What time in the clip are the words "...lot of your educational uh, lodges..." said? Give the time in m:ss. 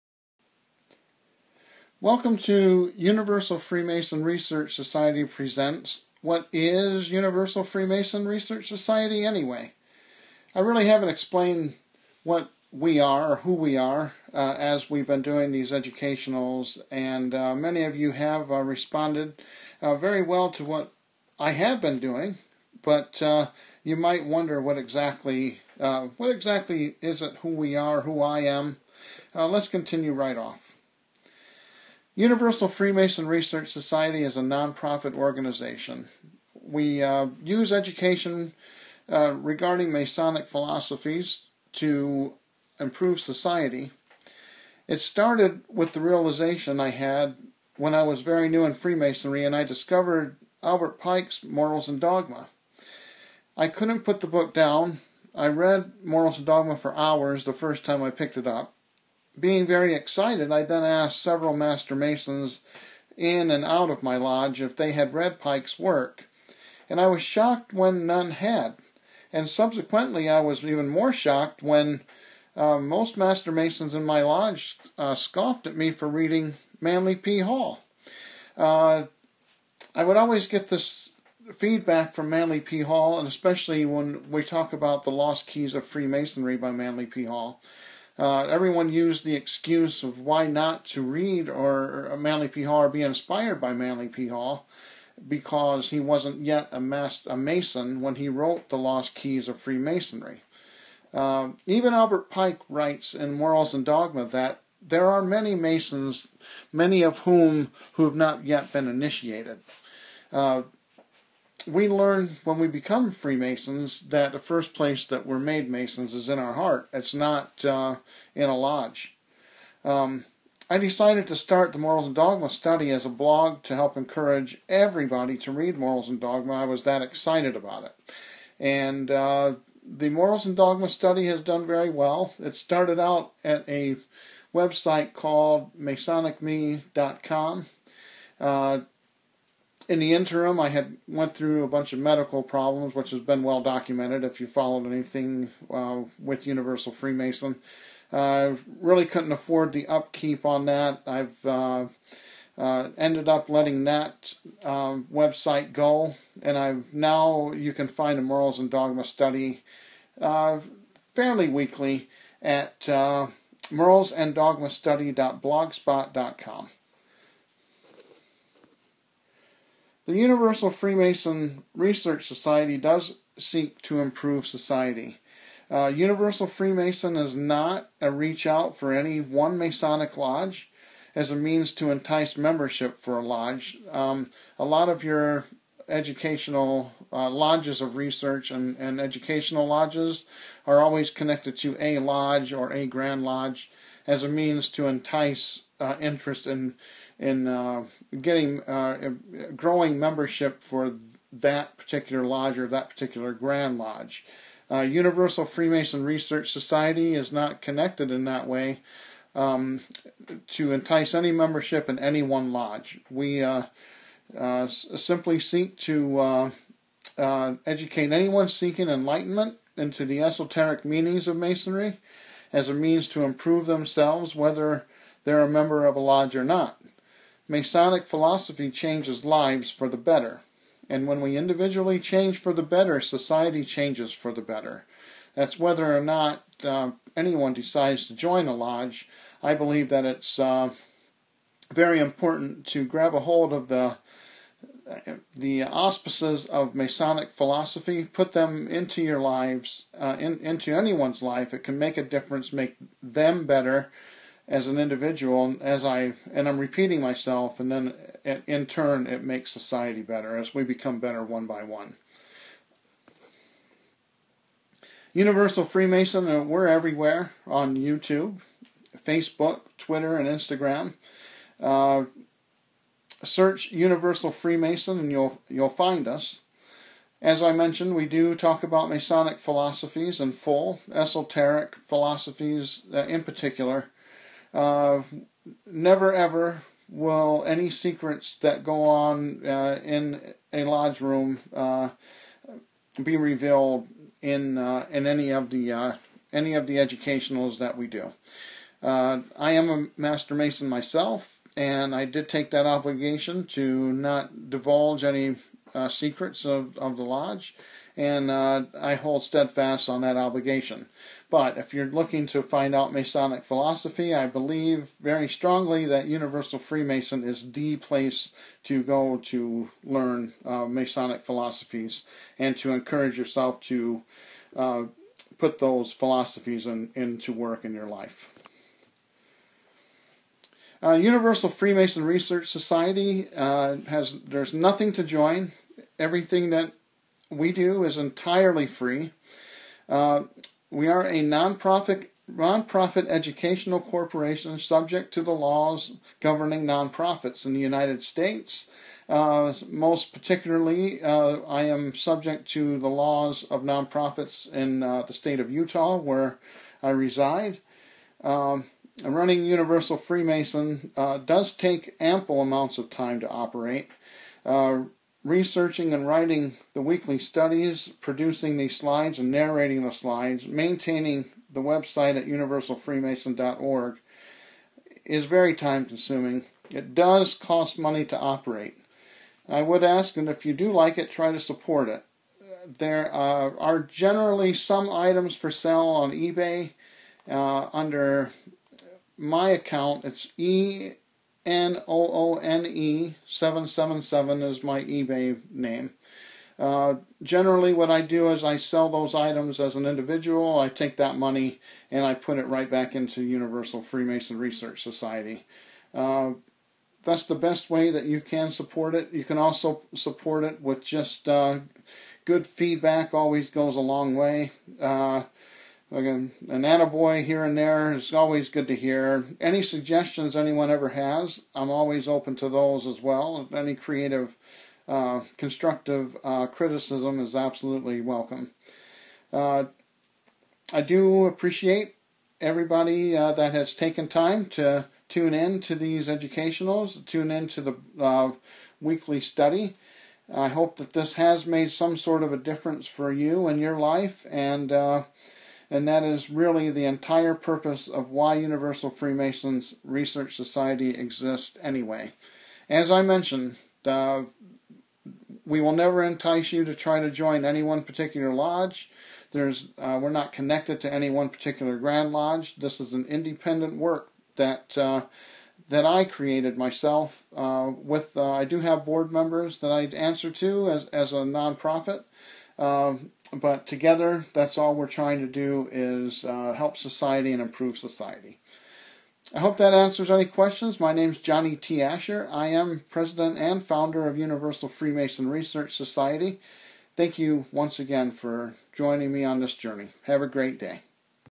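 3:04.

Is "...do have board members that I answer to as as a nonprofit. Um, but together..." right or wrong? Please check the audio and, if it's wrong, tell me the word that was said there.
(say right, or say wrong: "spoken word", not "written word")
right.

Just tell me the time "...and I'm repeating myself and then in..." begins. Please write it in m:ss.
4:16.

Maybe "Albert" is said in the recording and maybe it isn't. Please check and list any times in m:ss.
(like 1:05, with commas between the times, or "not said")
0:50, 1:41.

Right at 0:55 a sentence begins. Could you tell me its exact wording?
I read Morals and Dogma for hours the first time I picked it up.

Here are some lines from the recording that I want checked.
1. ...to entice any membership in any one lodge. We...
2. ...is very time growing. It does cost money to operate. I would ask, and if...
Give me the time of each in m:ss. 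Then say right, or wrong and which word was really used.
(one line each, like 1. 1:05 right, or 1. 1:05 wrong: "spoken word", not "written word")
1. 3:30 right
2. 6:15 wrong: "consuming", not "growing".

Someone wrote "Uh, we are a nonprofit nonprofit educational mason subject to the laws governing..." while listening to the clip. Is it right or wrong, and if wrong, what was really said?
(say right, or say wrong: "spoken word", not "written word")
wrong: "corporation", not "mason".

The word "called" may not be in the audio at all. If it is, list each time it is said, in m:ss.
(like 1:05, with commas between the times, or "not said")
2:15.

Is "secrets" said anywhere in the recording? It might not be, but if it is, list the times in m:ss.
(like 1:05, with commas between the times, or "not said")
4:47, 5:05.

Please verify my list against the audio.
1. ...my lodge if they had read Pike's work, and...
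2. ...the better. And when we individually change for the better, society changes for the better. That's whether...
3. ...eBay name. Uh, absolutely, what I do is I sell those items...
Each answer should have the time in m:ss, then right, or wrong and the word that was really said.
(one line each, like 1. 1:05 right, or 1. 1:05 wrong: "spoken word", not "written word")
1. 1:04 right
2. 3:49 right
3. 6:34 wrong: "generally", not "absolutely".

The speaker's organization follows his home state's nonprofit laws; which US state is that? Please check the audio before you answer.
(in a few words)
Utah.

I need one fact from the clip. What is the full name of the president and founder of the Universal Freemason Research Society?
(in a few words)
Johnny T. Asher.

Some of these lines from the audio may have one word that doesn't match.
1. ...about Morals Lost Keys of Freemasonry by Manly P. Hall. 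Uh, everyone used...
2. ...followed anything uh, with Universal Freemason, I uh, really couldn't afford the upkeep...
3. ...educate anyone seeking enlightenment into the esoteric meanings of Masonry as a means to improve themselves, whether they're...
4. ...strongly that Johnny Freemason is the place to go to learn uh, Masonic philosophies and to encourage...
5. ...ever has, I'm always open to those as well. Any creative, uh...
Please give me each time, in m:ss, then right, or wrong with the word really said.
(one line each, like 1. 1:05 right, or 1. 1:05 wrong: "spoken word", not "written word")
1. 1:24 wrong: "The", not "Morals"
2. 2:24 right
3. 3:37 right
4. 5:15 wrong: "Universal", not "Johnny"
5. 7:00 right.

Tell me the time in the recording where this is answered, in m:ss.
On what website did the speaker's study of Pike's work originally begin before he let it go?
2:15.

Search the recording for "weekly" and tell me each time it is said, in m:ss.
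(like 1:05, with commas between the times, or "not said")
2:41, 6:06, 7:18.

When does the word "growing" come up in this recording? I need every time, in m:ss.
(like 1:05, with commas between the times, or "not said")
3:19.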